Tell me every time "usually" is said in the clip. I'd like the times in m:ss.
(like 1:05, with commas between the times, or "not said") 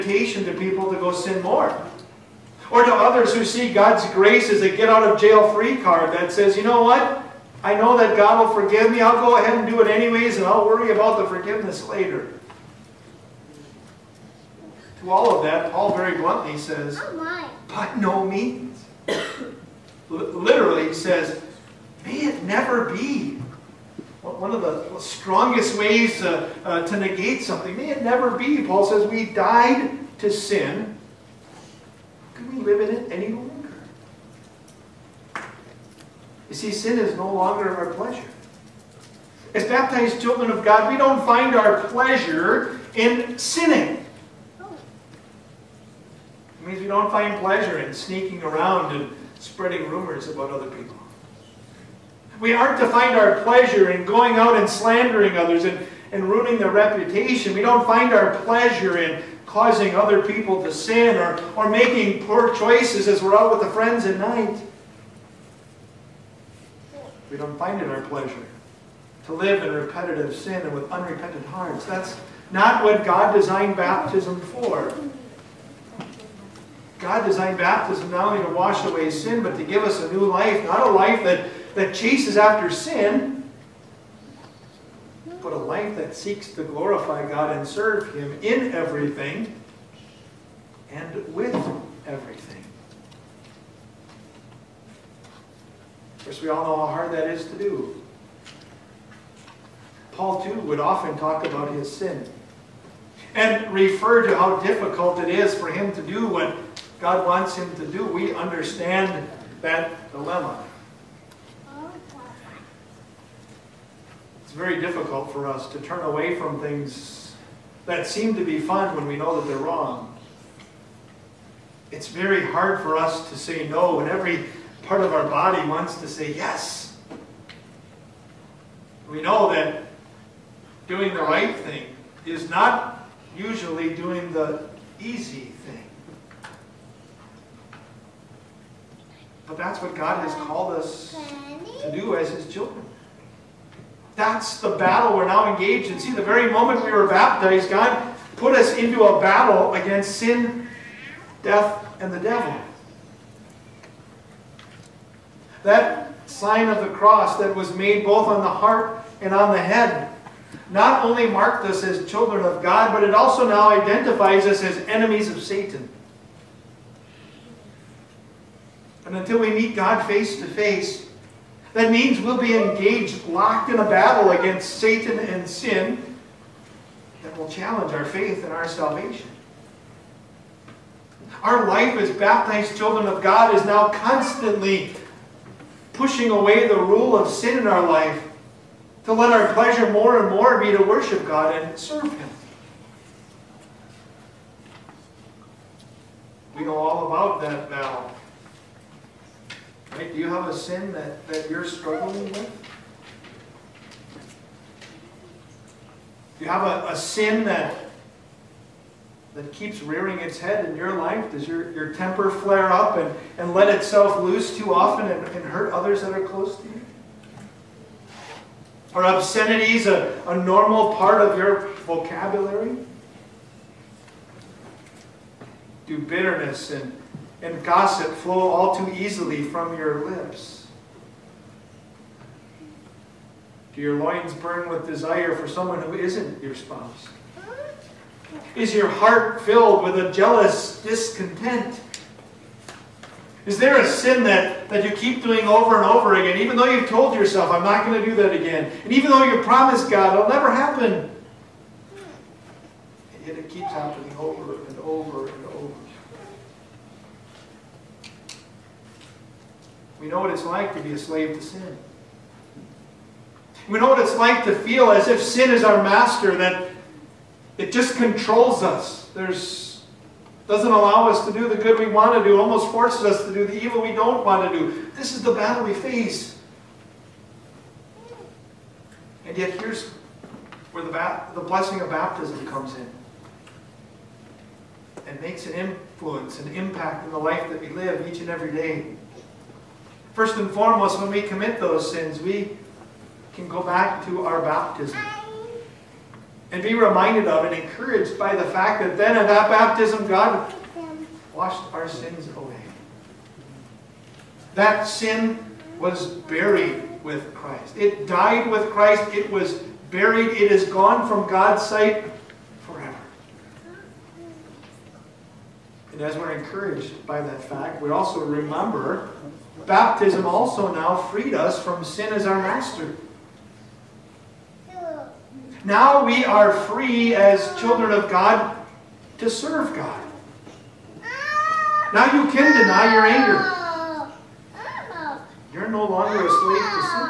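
2:13.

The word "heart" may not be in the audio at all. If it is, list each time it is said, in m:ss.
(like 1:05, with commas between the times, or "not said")
1:11, 2:38, 3:58.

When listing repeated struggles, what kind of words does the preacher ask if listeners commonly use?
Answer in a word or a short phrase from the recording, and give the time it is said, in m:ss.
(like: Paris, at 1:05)
Obscenities, at 3:39.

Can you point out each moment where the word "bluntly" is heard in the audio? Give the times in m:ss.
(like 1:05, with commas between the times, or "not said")
0:16.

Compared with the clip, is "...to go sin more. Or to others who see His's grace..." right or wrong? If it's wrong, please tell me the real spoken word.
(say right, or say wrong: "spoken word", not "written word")
wrong: "God", not "His".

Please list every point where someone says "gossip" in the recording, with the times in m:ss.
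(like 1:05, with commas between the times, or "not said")
3:47.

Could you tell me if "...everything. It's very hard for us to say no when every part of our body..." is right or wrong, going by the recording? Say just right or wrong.
wrong.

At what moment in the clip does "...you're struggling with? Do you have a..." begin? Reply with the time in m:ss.
3:21.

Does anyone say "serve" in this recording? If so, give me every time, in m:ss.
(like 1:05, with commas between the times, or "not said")
1:27, 3:11, 5:29.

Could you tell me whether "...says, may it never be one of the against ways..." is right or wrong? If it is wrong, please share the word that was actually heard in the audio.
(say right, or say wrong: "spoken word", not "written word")
wrong: "strongest", not "against".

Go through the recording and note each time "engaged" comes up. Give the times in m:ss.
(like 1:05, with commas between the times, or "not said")
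2:25, 2:52.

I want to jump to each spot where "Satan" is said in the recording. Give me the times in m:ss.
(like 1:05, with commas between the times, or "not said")
2:45, 2:54.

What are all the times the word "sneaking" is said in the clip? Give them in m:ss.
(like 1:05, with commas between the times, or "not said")
0:47.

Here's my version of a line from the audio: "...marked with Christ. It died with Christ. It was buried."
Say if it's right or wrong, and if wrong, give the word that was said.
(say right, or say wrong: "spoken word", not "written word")
wrong: "buried", not "marked".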